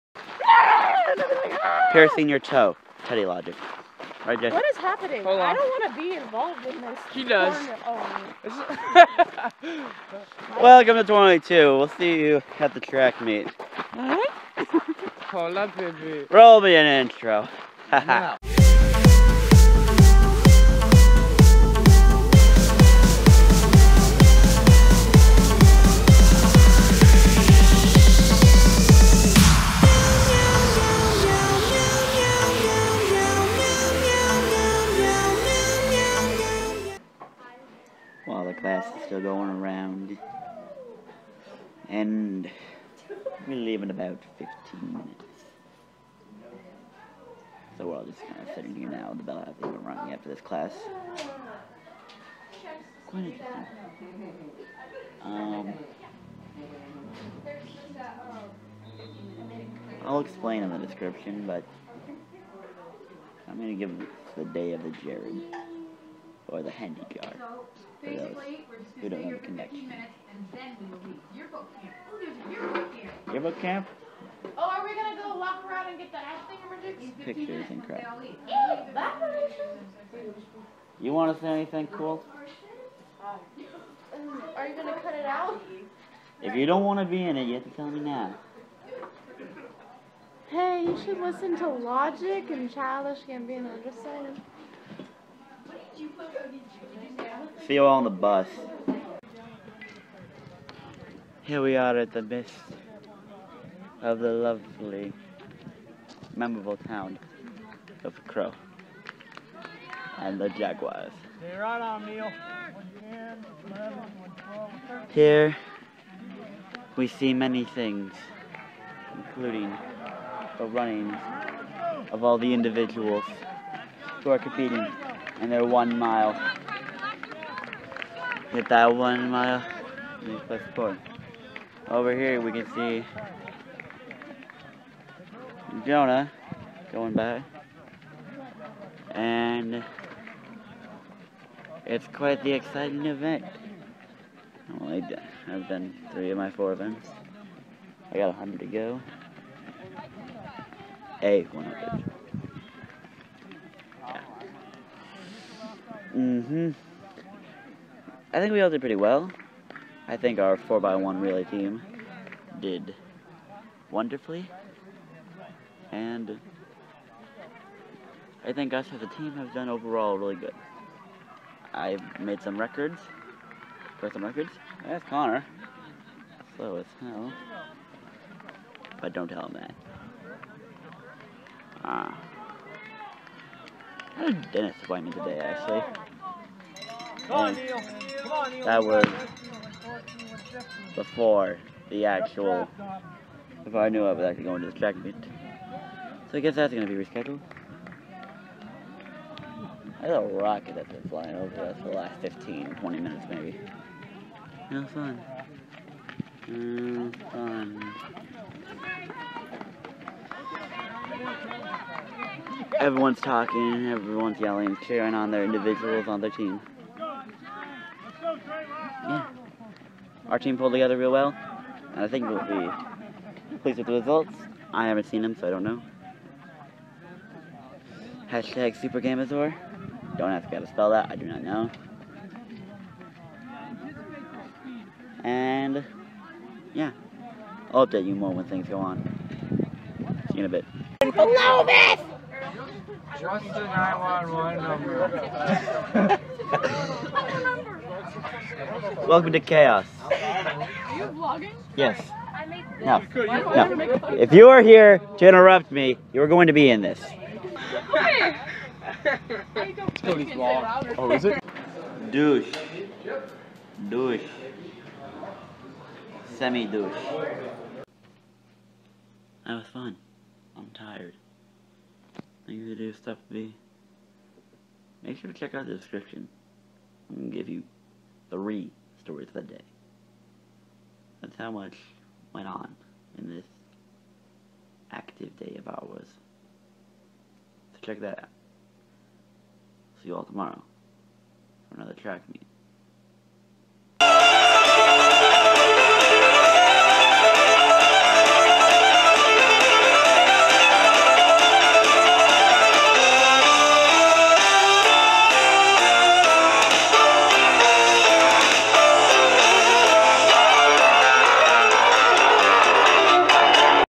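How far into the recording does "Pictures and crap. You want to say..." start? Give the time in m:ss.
1:17.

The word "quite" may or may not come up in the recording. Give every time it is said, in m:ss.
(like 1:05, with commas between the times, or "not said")
0:53, 2:22.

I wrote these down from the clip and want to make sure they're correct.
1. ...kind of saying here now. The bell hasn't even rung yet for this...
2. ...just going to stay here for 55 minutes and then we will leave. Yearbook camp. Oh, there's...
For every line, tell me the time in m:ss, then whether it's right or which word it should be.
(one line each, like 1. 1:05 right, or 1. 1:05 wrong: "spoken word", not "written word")
1. 0:48 wrong: "sitting", not "saying"
2. 1:08 wrong: "15", not "55".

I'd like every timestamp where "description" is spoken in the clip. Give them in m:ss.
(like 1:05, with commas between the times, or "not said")
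1:00, 4:35.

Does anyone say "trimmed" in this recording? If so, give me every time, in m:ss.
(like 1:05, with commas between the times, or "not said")
not said.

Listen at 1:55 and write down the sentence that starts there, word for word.
Here we see many things, including the running of all the individuals who are competing and they're one mile.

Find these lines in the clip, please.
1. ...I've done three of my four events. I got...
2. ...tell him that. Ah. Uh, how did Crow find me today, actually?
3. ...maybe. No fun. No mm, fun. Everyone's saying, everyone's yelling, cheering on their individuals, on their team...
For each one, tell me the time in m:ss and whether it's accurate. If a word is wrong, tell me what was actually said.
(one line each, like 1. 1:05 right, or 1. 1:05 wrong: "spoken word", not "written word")
1. 2:25 right
2. 2:59 wrong: "Dennis", not "Crow"
3. 3:23 wrong: "talking", not "saying".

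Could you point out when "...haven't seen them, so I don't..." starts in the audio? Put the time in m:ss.
3:44.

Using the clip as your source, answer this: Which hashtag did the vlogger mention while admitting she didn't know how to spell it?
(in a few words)
Super Gamazor.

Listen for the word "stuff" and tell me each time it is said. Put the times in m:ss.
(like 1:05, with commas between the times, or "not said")
4:32.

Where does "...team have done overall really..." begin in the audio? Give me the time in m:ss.
2:49.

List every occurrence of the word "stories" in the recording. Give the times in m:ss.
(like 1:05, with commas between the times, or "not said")
4:39.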